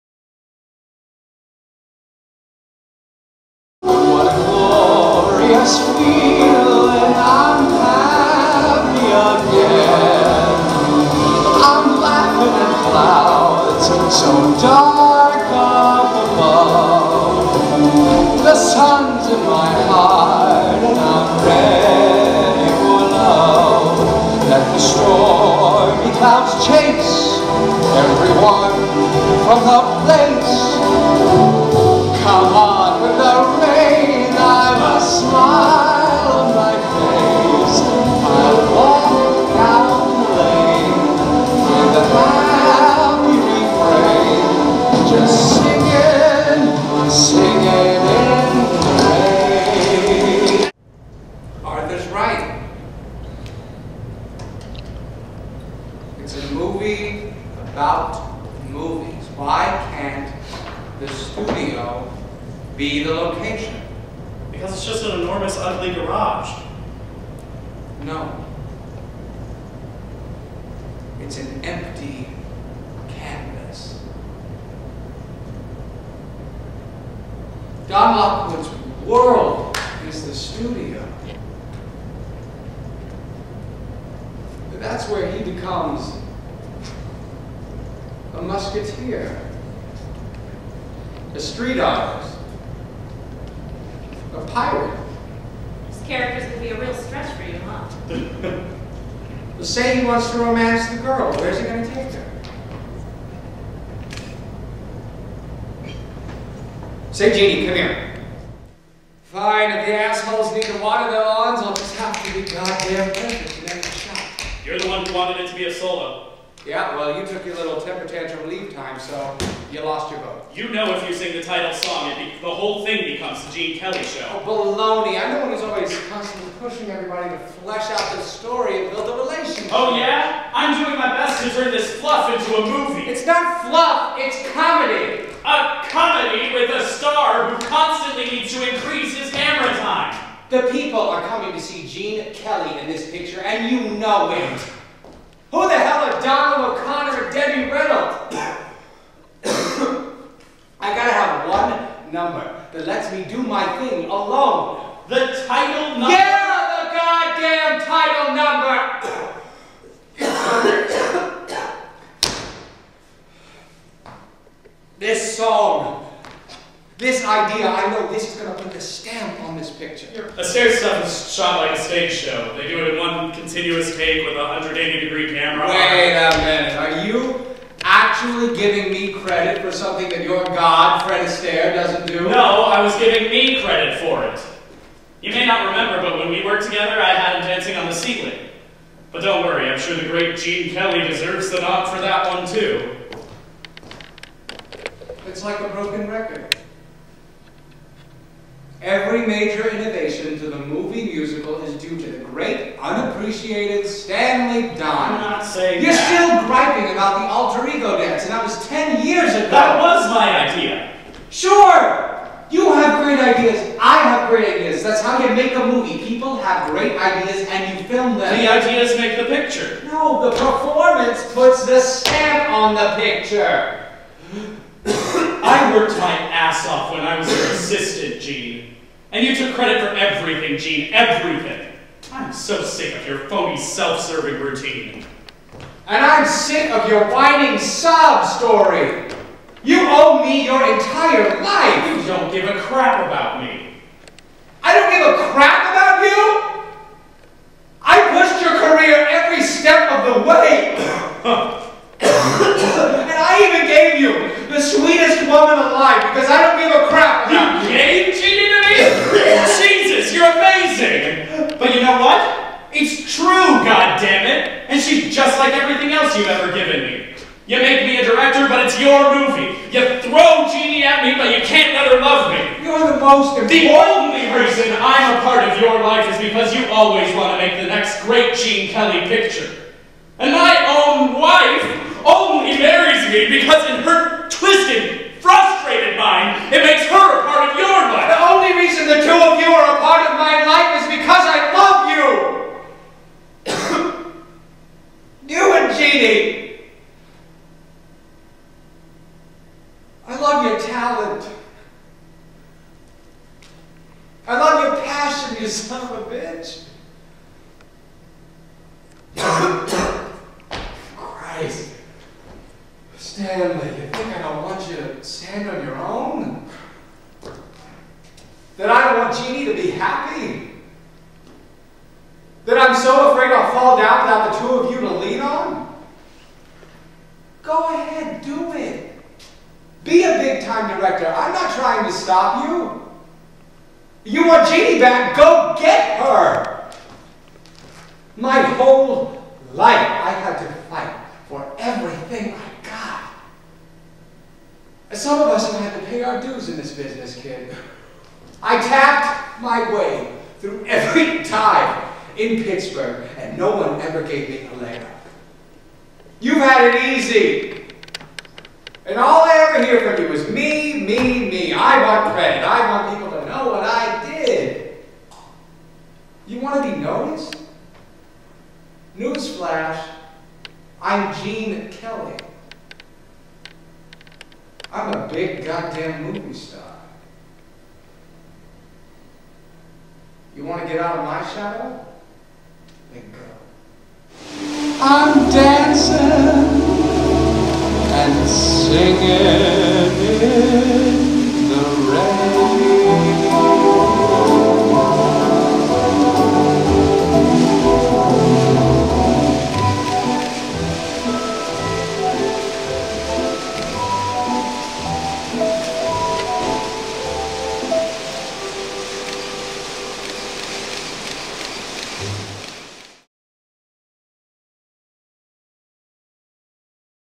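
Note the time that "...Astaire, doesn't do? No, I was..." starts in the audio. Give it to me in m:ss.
3:01.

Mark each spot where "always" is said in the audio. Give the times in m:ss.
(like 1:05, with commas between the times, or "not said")
2:05, 4:36.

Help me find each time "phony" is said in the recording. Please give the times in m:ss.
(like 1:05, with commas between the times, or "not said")
3:53.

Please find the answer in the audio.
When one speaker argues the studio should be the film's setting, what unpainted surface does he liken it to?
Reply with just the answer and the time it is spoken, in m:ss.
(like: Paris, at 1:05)
An empty canvas, at 1:11.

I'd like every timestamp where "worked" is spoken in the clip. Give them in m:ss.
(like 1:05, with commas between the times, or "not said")
3:06, 3:45.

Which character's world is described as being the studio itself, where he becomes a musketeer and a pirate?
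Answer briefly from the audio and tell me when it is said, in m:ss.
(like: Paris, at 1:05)
Don Lockwood, at 1:17.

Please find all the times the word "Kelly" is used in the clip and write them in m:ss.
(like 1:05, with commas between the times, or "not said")
2:03, 2:22, 3:10, 4:38, 6:11.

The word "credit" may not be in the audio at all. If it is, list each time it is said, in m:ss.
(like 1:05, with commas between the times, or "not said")
2:59, 3:03, 3:49, 6:02.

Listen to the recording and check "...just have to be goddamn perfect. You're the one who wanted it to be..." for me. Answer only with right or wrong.
right.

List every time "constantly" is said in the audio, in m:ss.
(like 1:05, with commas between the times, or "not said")
2:06, 2:17.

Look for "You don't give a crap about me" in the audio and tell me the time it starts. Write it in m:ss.
4:01.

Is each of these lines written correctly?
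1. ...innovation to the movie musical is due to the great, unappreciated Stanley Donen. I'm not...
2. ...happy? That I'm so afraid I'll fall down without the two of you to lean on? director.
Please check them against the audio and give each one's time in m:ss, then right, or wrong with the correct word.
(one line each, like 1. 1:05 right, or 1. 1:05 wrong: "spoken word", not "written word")
1. 3:19 right
2. 5:19 right.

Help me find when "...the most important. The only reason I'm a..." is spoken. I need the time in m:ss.
4:32.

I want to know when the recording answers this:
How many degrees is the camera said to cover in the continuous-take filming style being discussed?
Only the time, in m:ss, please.
2:54.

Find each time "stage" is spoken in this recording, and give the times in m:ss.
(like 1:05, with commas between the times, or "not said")
2:51.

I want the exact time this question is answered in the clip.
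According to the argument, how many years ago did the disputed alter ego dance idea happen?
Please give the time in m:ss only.
3:28.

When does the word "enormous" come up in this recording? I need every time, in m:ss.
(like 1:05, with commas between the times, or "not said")
1:05.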